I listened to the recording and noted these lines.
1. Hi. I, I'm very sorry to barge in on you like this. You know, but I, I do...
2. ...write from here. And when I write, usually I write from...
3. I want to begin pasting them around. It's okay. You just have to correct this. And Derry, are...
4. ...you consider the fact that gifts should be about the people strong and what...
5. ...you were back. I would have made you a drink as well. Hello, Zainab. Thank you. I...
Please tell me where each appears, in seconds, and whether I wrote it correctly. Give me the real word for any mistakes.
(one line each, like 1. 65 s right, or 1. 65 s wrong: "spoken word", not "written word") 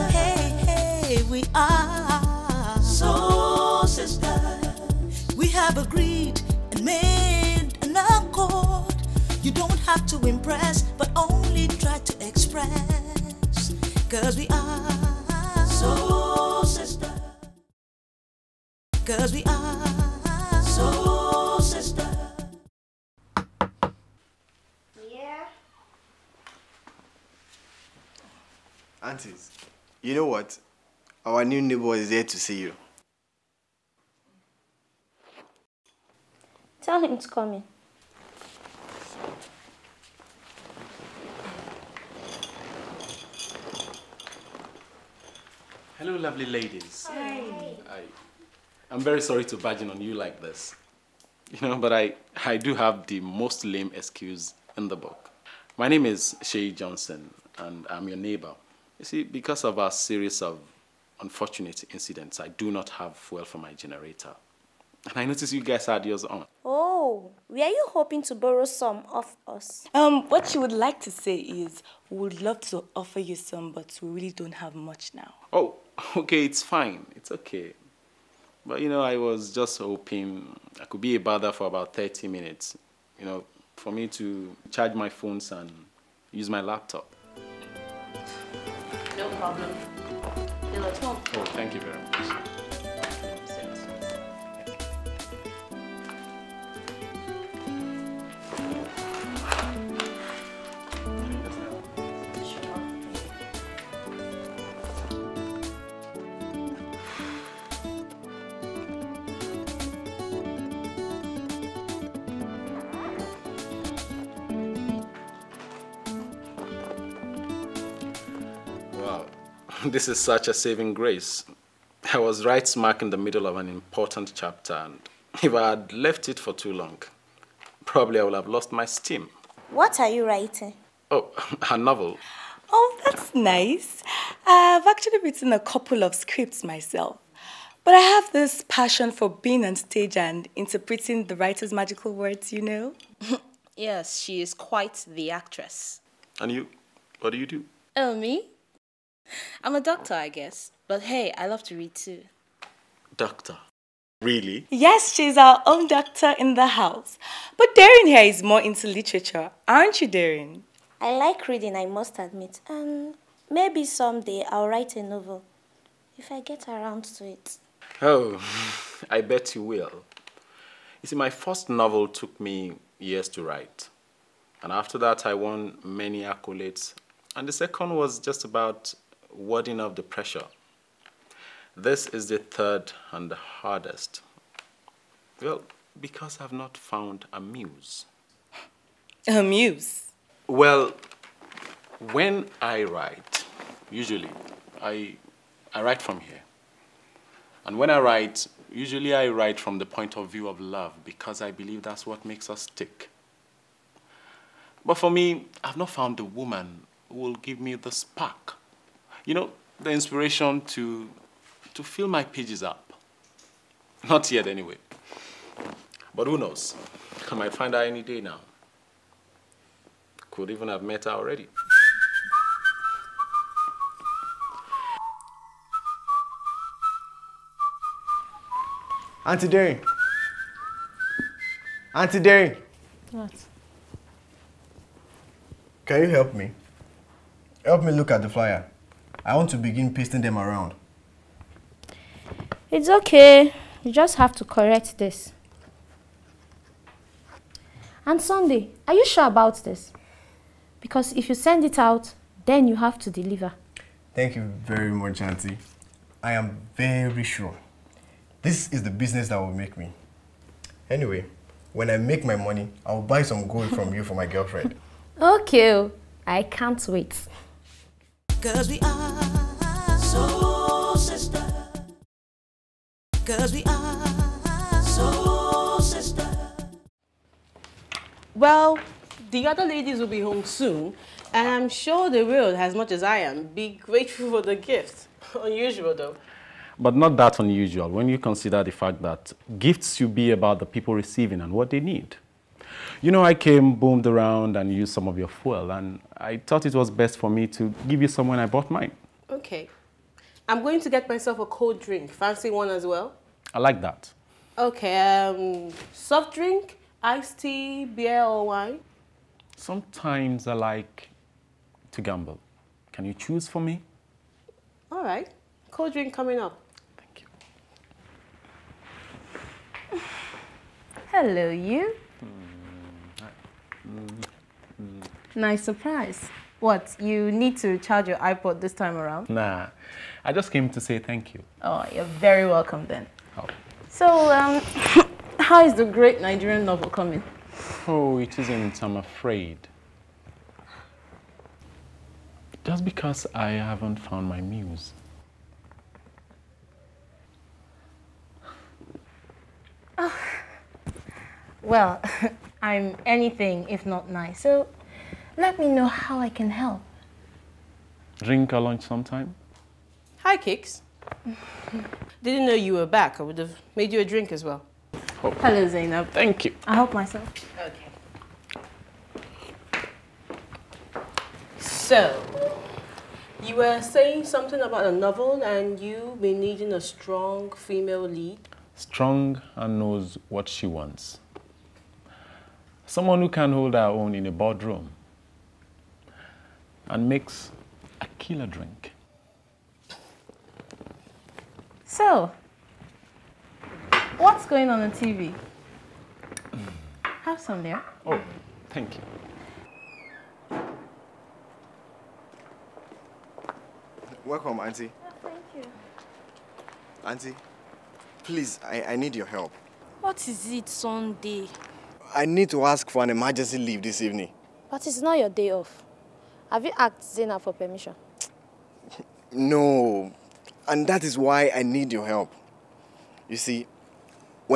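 1. 47 s right
2. 195 s right
3. 239 s wrong: "Sunday", not "Derry"
4. 288 s wrong: "receiving", not "strong"
5. 362 s right.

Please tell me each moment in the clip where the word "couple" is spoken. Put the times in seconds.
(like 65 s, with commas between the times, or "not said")
135 s.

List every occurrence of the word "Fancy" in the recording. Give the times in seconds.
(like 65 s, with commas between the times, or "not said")
302 s.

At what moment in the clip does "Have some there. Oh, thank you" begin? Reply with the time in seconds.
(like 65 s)
397 s.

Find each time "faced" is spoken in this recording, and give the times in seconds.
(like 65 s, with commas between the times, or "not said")
not said.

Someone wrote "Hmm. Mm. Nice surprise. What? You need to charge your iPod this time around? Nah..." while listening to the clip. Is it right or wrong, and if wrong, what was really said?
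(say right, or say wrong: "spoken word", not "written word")
right.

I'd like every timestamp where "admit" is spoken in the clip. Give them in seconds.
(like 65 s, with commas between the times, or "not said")
162 s.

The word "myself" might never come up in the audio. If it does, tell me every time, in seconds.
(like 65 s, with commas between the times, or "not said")
136 s, 301 s, 366 s.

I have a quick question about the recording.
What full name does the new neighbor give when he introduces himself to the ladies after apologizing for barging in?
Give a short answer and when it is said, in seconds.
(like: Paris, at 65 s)
Shay Johnson, at 56 s.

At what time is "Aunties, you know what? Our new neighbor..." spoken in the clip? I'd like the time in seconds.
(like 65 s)
29 s.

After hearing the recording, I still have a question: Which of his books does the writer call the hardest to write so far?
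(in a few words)
The third.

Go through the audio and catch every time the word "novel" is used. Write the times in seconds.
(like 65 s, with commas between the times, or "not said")
131 s, 165 s, 171 s, 336 s, 374 s.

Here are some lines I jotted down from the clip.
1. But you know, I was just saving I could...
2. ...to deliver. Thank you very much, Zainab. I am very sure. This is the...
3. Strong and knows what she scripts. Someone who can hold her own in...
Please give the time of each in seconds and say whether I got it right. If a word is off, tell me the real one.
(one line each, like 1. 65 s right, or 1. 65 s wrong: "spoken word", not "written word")
1. 78 s wrong: "hoping", not "saving"
2. 253 s wrong: "Auntie", not "Zainab"
3. 378 s wrong: "wants", not "scripts".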